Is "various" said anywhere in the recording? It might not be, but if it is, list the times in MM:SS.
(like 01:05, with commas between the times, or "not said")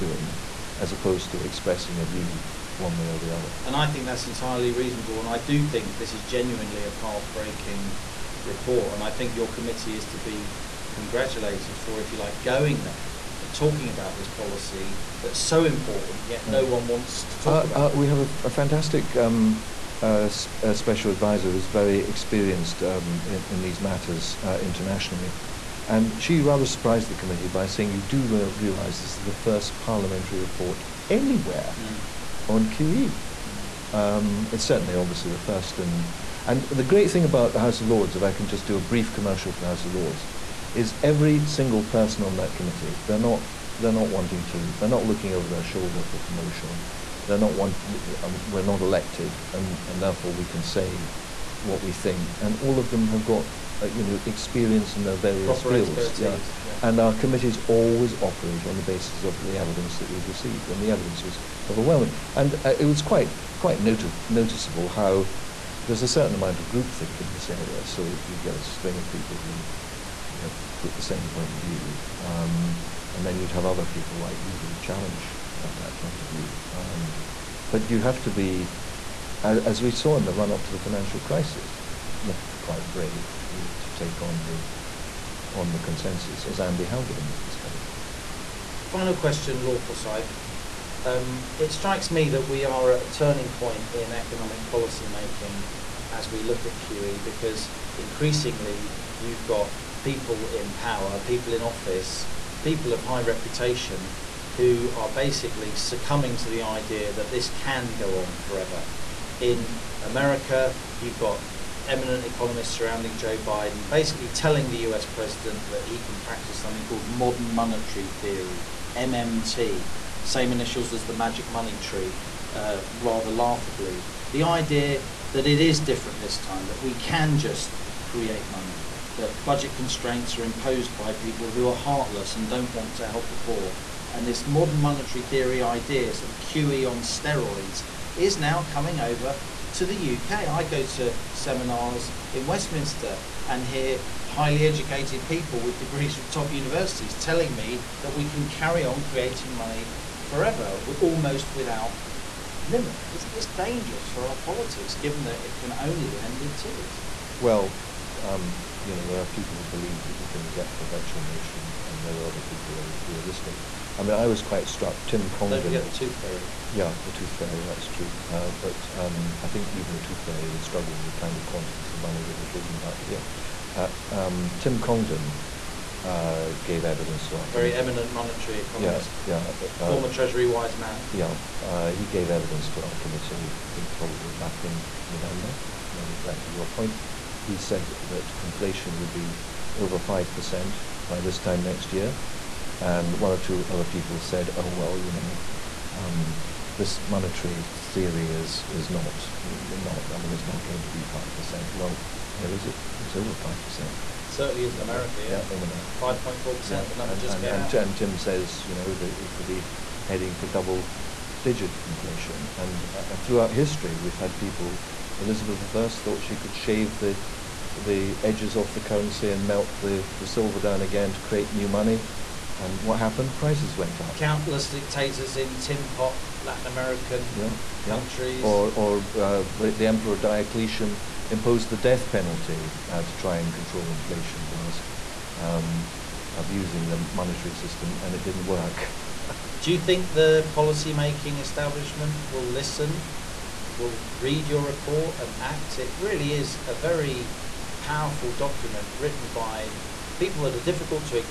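00:55.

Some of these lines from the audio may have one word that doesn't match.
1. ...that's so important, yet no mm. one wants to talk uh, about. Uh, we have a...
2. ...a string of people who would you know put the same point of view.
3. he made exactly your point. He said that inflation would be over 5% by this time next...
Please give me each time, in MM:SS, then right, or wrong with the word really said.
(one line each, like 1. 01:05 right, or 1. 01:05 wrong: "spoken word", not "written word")
1. 00:15 right
2. 01:08 right
3. 03:05 right.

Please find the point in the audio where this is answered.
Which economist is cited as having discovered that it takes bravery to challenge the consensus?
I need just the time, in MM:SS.
01:26.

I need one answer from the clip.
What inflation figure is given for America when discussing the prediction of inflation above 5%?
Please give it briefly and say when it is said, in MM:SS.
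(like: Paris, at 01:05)
5.4%, at 03:25.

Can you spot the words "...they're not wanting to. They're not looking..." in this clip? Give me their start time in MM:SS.
00:43.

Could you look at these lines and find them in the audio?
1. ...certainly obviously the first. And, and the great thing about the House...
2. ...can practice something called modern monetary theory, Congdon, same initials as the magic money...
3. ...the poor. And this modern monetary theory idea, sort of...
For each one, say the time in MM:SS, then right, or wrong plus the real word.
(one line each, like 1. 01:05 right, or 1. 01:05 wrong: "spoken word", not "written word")
1. 00:34 right
2. 01:56 wrong: "MMT", not "Congdon"
3. 02:13 right.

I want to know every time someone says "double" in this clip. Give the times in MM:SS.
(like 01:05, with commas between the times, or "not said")
03:30.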